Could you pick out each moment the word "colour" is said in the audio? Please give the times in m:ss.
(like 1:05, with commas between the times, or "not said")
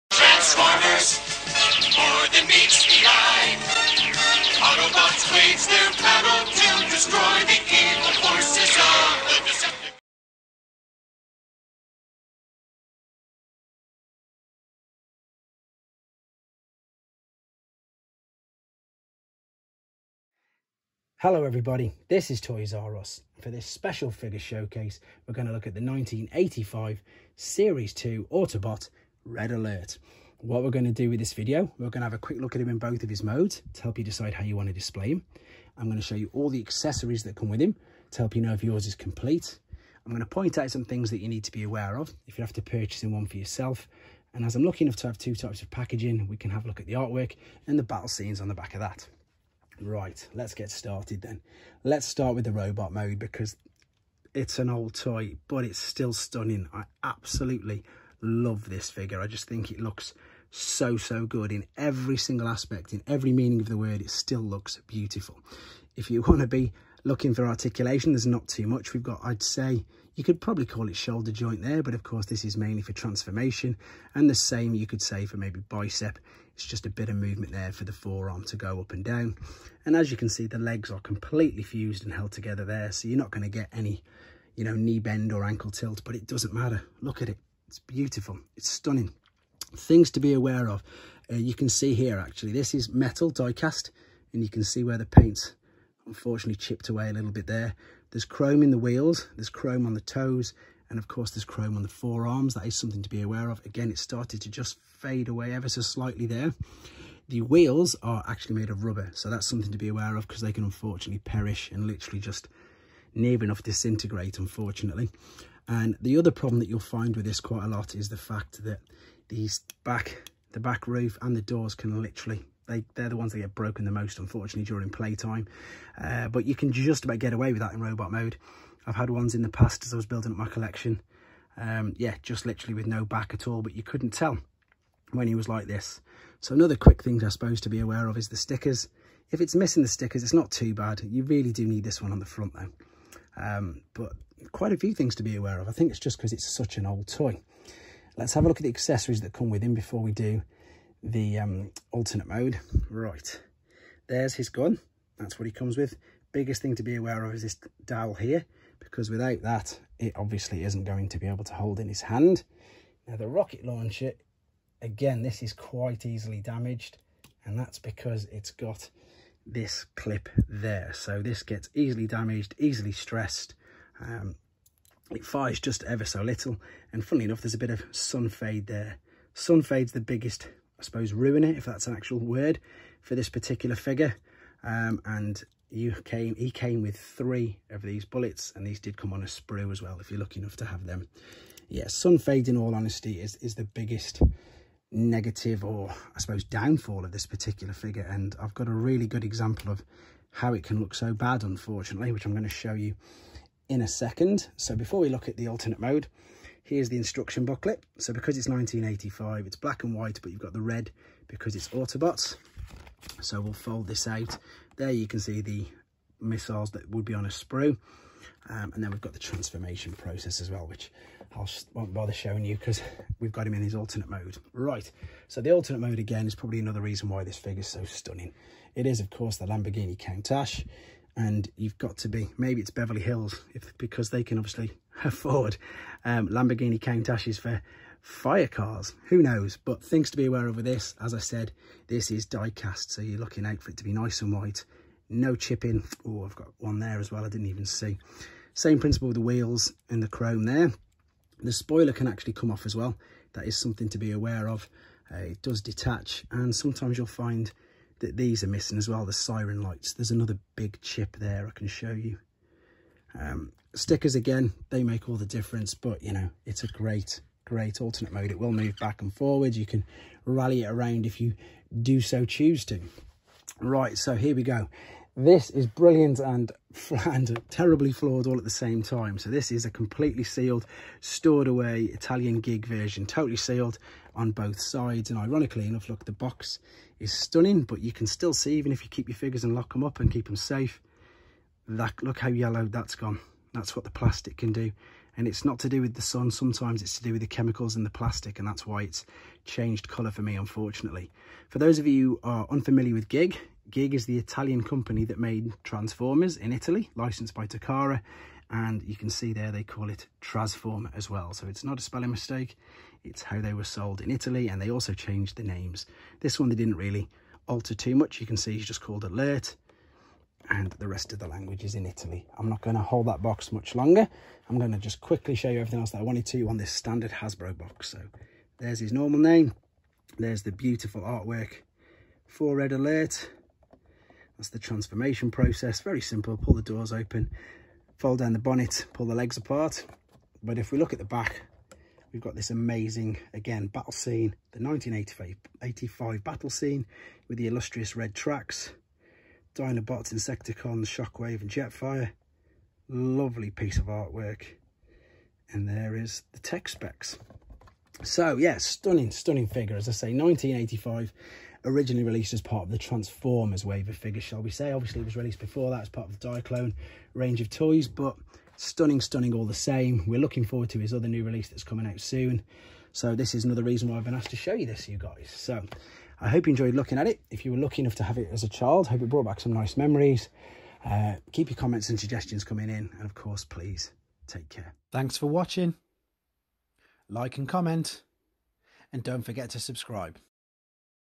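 4:59.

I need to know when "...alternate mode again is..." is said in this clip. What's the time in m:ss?
3:45.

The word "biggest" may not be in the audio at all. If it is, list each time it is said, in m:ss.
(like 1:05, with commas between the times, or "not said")
2:36, 3:00, 3:13.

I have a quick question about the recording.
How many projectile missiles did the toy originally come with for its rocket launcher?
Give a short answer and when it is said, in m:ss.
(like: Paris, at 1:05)
3, at 3:06.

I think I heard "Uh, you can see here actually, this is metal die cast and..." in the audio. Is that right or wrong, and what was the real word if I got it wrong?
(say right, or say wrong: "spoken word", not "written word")
right.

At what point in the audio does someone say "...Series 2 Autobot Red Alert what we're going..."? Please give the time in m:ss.
0:27.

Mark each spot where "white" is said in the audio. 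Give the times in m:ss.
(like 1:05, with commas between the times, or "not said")
3:29, 4:04.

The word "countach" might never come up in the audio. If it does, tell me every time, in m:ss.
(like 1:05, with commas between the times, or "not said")
3:49, 3:56.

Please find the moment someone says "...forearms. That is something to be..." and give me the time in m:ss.
1:41.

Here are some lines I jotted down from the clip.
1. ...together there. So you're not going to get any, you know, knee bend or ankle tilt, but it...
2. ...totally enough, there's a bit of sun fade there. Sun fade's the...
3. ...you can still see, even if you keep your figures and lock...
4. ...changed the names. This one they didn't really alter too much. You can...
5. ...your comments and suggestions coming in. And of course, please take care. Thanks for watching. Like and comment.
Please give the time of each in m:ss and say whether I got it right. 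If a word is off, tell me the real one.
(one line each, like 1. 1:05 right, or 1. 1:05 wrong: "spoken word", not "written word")
1. 1:22 right
2. 2:57 wrong: "funnily", not "totally"
3. 4:47 right
4. 5:14 right
5. 6:21 right.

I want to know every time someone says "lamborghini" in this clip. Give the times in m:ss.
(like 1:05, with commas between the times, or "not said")
3:49, 3:56.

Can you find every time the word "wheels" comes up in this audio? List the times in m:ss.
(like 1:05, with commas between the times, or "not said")
1:38, 1:47, 4:09.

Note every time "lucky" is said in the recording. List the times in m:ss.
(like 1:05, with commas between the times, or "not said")
0:44, 3:10, 6:17.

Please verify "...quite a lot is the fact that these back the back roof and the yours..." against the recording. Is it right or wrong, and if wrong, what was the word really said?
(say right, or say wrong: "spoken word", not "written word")
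wrong: "doors", not "yours".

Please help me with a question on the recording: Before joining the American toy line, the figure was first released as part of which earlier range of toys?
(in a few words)
Diaclone.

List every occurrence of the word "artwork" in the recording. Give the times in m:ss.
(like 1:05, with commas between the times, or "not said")
0:46, 5:31, 5:53.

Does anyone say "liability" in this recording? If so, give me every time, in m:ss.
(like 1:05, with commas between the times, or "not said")
not said.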